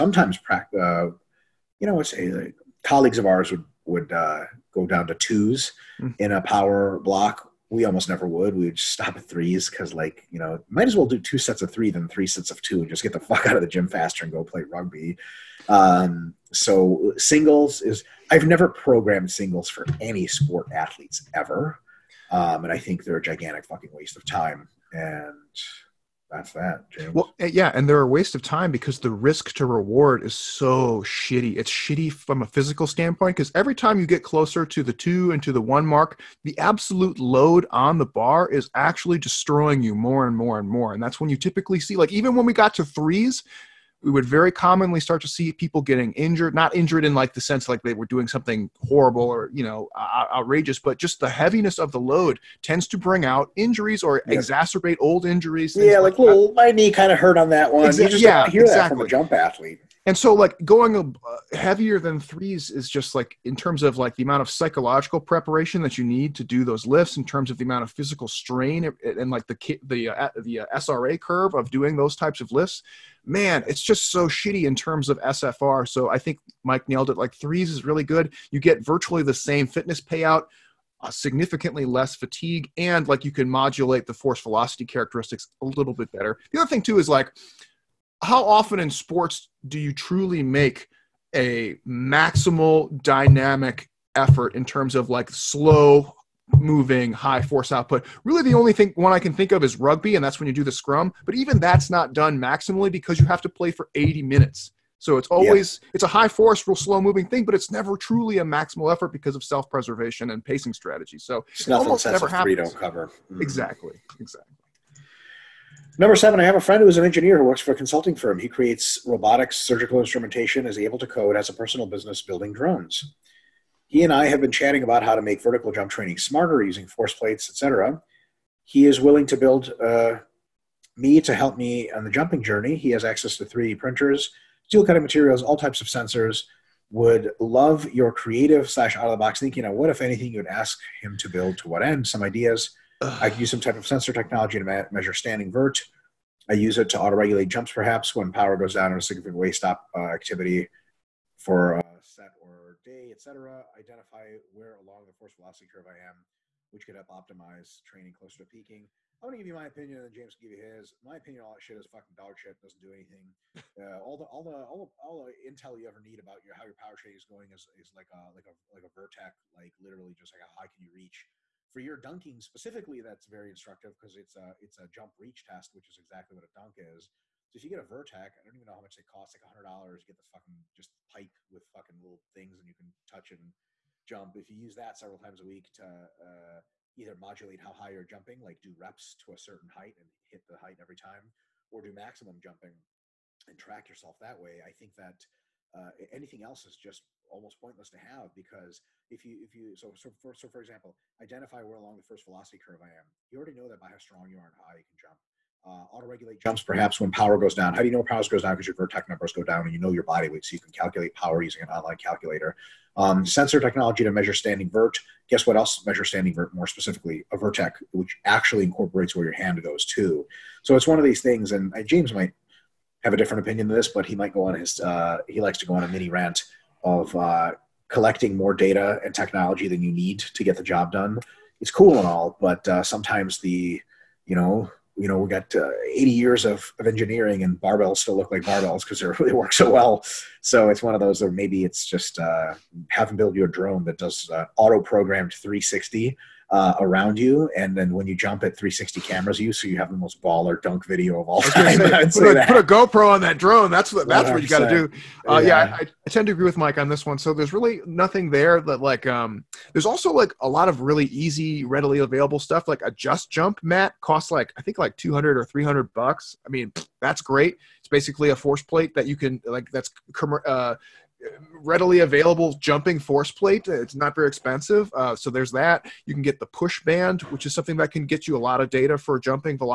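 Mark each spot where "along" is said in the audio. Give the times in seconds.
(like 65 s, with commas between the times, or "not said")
154 s, 201 s.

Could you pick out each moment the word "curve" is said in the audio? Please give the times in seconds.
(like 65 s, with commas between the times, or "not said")
71 s, 155 s, 202 s.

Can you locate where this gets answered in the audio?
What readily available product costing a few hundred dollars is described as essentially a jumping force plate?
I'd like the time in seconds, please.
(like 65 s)
262 s.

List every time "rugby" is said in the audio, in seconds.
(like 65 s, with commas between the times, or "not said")
14 s, 99 s.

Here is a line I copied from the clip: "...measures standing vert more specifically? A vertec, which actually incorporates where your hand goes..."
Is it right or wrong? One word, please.
right.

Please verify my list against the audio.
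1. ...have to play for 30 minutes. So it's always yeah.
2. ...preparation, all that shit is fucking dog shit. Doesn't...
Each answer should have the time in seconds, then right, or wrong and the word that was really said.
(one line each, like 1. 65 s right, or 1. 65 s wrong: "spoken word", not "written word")
1. 103 s wrong: "80", not "30"
2. 161 s wrong: "opinion", not "preparation".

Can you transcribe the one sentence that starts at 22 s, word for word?
Um, and I think they're a gigantic fucking waste of time and that's that.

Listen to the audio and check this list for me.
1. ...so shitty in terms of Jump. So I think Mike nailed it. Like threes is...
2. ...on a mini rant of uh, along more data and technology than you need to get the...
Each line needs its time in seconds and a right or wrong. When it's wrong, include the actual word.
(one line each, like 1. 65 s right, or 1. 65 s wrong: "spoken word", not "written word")
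1. 74 s wrong: "SFR", not "Jump"
2. 225 s wrong: "collecting", not "along".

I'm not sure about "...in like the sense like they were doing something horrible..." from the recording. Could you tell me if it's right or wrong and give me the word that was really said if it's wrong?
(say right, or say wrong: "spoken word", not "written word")
right.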